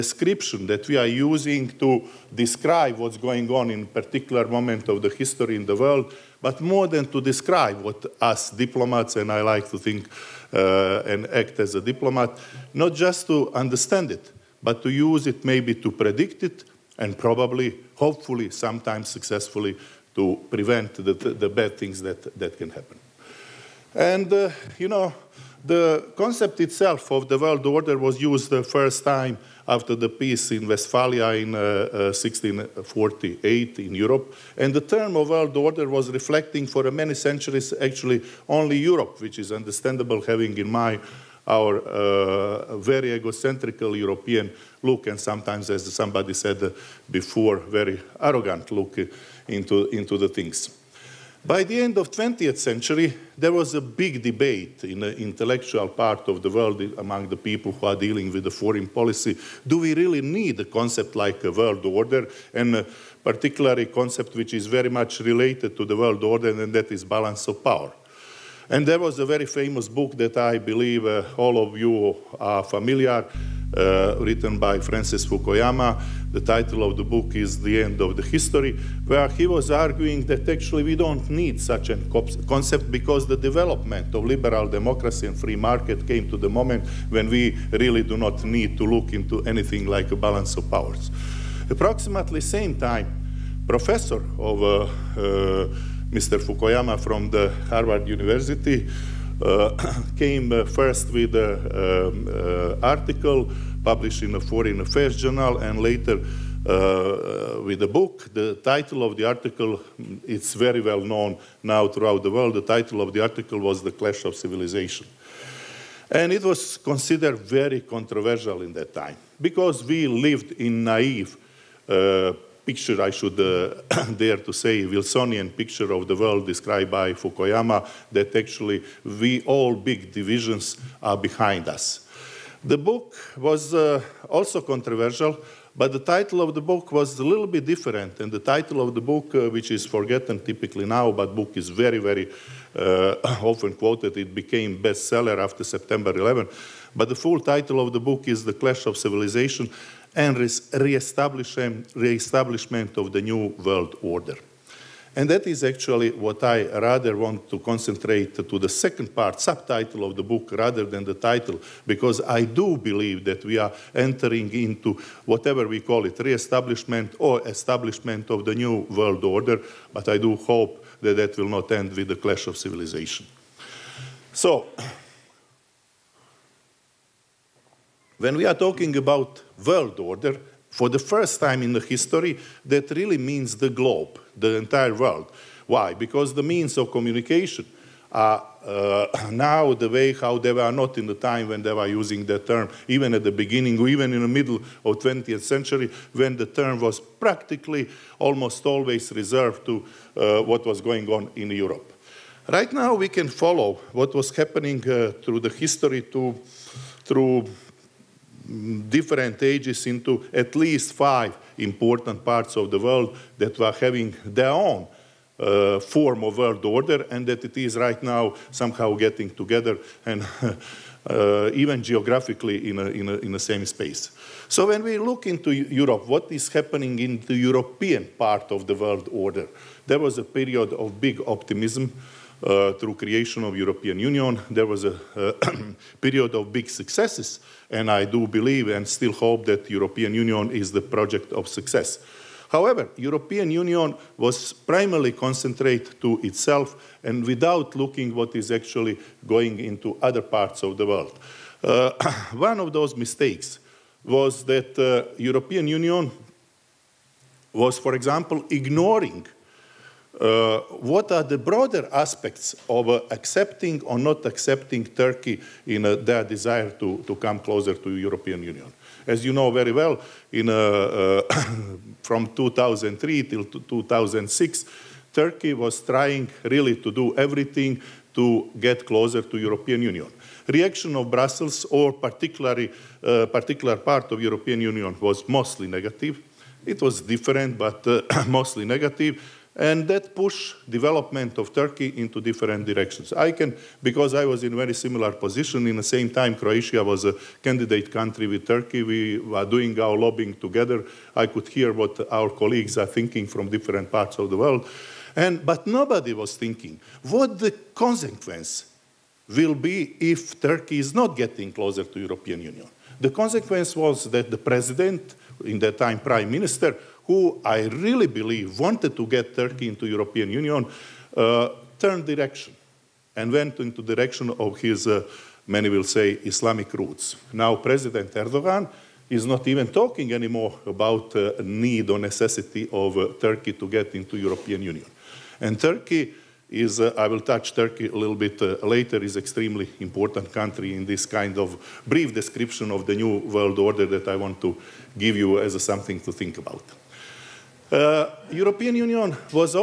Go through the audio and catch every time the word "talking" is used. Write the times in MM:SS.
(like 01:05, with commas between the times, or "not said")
02:58, 05:29.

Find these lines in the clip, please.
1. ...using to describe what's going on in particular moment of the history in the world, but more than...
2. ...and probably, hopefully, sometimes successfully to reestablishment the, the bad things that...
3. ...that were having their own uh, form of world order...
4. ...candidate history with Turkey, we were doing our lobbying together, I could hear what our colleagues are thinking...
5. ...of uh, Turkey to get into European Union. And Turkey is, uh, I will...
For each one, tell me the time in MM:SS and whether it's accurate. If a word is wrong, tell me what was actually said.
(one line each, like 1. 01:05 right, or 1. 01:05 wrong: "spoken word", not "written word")
1. 00:01 right
2. 00:16 wrong: "prevent", not "reestablishment"
3. 03:33 right
4. 04:57 wrong: "country", not "history"
5. 05:32 right.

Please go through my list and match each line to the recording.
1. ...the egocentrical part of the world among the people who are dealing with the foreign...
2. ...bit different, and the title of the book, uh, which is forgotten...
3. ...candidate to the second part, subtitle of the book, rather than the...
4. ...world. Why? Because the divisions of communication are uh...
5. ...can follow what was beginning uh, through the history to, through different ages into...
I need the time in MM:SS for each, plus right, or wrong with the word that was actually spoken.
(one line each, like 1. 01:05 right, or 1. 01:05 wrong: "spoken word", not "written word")
1. 00:54 wrong: "intellectual", not "egocentrical"
2. 02:17 right
3. 02:37 wrong: "concentrate", not "candidate"
4. 03:04 wrong: "means", not "divisions"
5. 03:23 wrong: "happening", not "beginning".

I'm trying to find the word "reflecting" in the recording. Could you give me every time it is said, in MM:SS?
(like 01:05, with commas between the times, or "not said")
00:36.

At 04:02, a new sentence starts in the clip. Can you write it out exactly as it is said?
However, European Union was primarily concentrated to itself and without looking what is actually going into other parts of the world.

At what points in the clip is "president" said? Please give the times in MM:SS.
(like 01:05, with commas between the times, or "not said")
05:14, 05:27.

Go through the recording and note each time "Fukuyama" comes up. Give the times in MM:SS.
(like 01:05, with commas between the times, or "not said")
01:15, 01:36, 02:07.